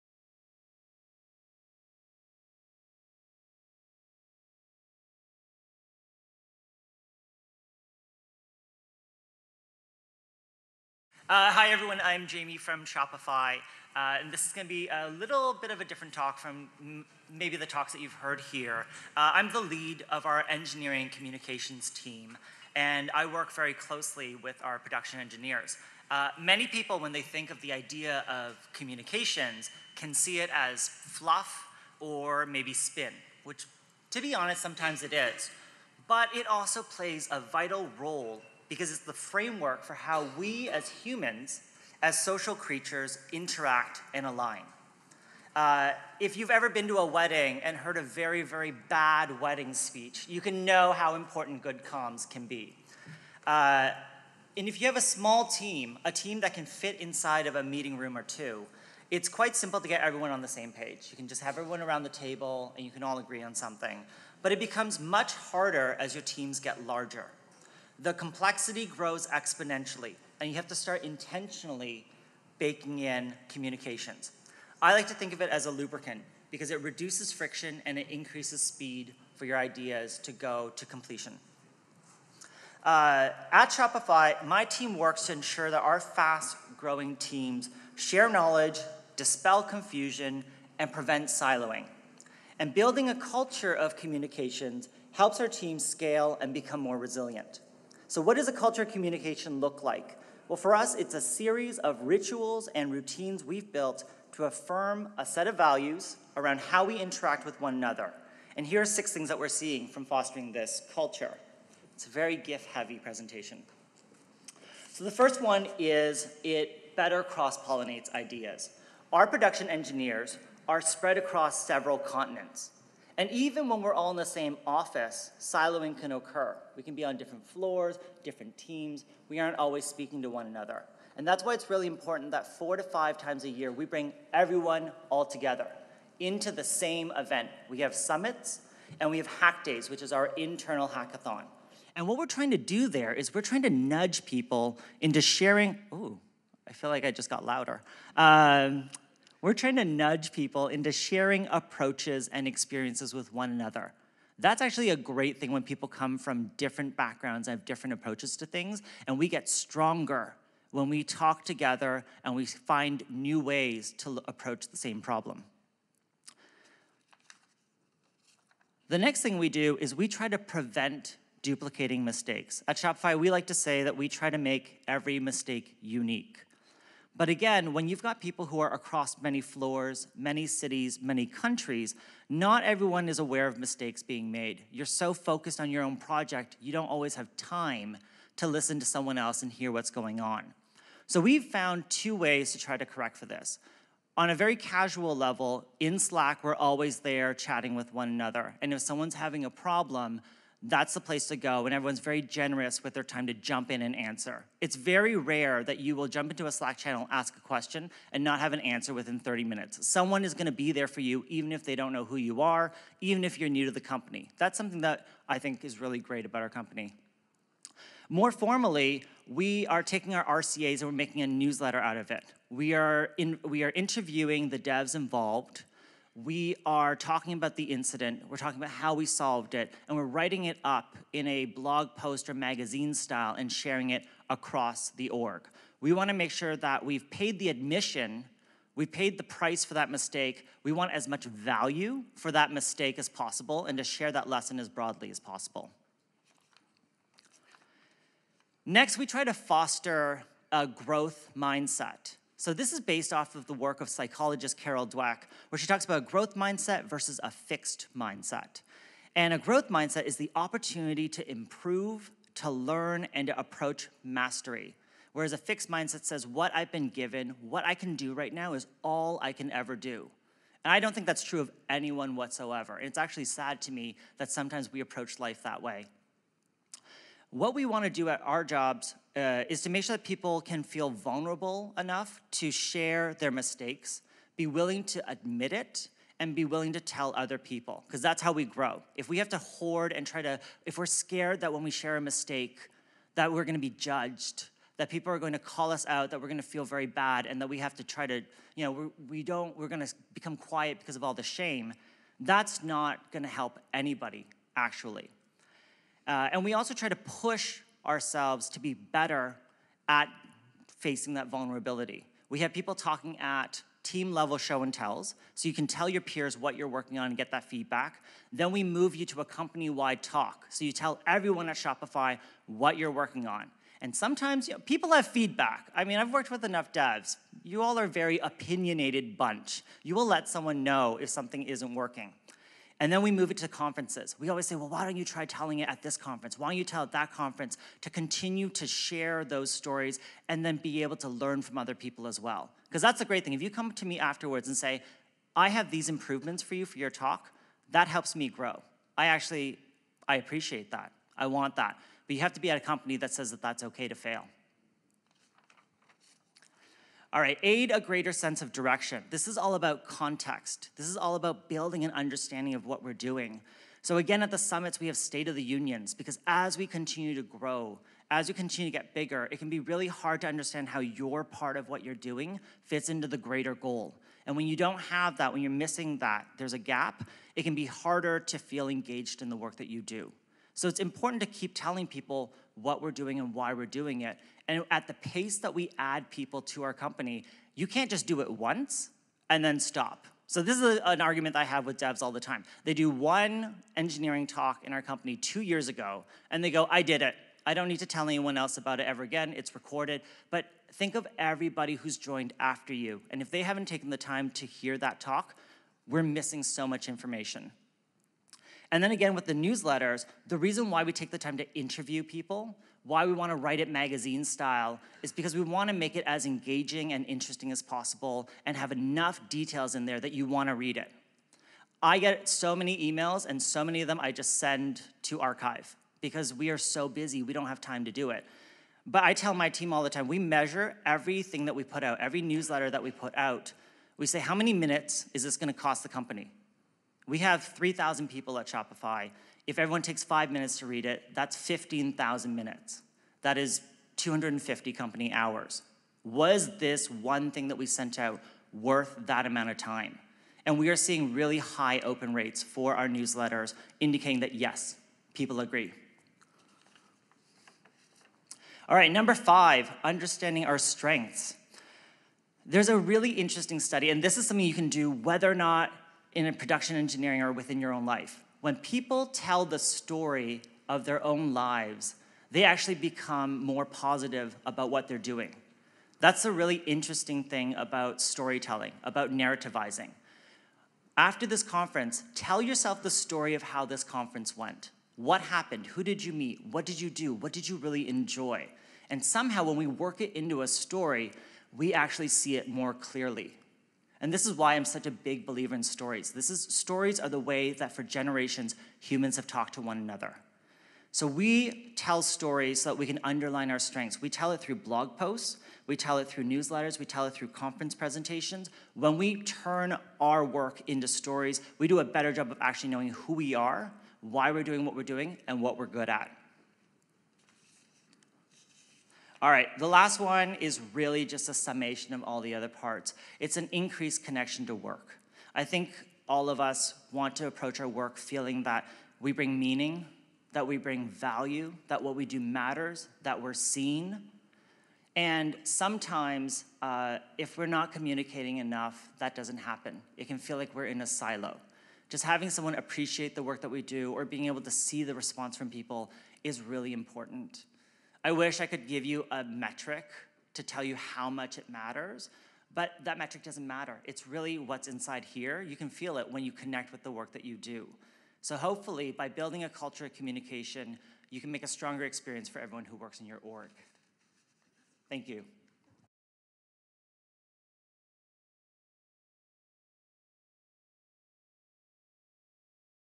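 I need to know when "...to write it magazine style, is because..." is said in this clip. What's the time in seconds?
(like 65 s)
413 s.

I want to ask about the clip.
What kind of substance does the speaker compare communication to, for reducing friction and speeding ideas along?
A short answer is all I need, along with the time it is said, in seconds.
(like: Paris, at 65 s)
A lubricant, at 75 s.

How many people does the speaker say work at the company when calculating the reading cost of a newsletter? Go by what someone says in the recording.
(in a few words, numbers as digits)
3,000.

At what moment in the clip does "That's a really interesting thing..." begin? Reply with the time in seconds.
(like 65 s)
475 s.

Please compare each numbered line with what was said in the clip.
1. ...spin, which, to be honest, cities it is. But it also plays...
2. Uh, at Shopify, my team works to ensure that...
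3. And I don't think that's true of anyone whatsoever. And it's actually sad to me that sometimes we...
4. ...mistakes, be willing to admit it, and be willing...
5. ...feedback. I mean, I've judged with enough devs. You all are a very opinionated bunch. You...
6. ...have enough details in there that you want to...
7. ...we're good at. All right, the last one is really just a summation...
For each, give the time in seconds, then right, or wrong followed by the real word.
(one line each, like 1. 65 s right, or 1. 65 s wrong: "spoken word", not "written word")
1. 32 s wrong: "sometimes", not "cities"
2. 82 s right
3. 270 s right
4. 283 s right
5. 325 s wrong: "worked", not "judged"
6. 418 s right
7. 515 s right.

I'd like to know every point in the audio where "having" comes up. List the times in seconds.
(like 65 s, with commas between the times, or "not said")
199 s, 542 s.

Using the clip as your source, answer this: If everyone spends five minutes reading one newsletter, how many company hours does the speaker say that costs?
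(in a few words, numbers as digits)
250.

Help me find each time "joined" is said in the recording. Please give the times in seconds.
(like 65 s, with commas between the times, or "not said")
401 s.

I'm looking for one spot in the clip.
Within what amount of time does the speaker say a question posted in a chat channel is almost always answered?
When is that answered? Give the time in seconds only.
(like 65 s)
209 s.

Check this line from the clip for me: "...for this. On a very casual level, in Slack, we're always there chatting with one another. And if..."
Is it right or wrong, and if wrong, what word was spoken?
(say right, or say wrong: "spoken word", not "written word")
right.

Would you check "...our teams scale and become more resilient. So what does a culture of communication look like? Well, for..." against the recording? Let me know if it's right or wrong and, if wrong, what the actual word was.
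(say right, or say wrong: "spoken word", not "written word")
right.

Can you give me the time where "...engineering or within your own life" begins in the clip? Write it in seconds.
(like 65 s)
466 s.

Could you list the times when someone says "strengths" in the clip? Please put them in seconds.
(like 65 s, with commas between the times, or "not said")
460 s, 503 s.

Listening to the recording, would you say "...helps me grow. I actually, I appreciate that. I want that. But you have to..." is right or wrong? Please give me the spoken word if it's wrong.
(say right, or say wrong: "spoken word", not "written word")
right.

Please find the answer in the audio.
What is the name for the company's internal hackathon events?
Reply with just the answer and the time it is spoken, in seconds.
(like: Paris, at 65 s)
Hack days, at 139 s.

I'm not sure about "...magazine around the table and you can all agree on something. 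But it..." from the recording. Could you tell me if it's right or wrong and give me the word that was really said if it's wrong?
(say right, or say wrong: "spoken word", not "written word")
wrong: "everyone", not "magazine".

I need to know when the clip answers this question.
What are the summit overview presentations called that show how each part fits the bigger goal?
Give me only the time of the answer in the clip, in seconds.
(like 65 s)
364 s.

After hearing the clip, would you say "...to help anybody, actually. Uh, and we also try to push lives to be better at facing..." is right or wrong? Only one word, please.
wrong.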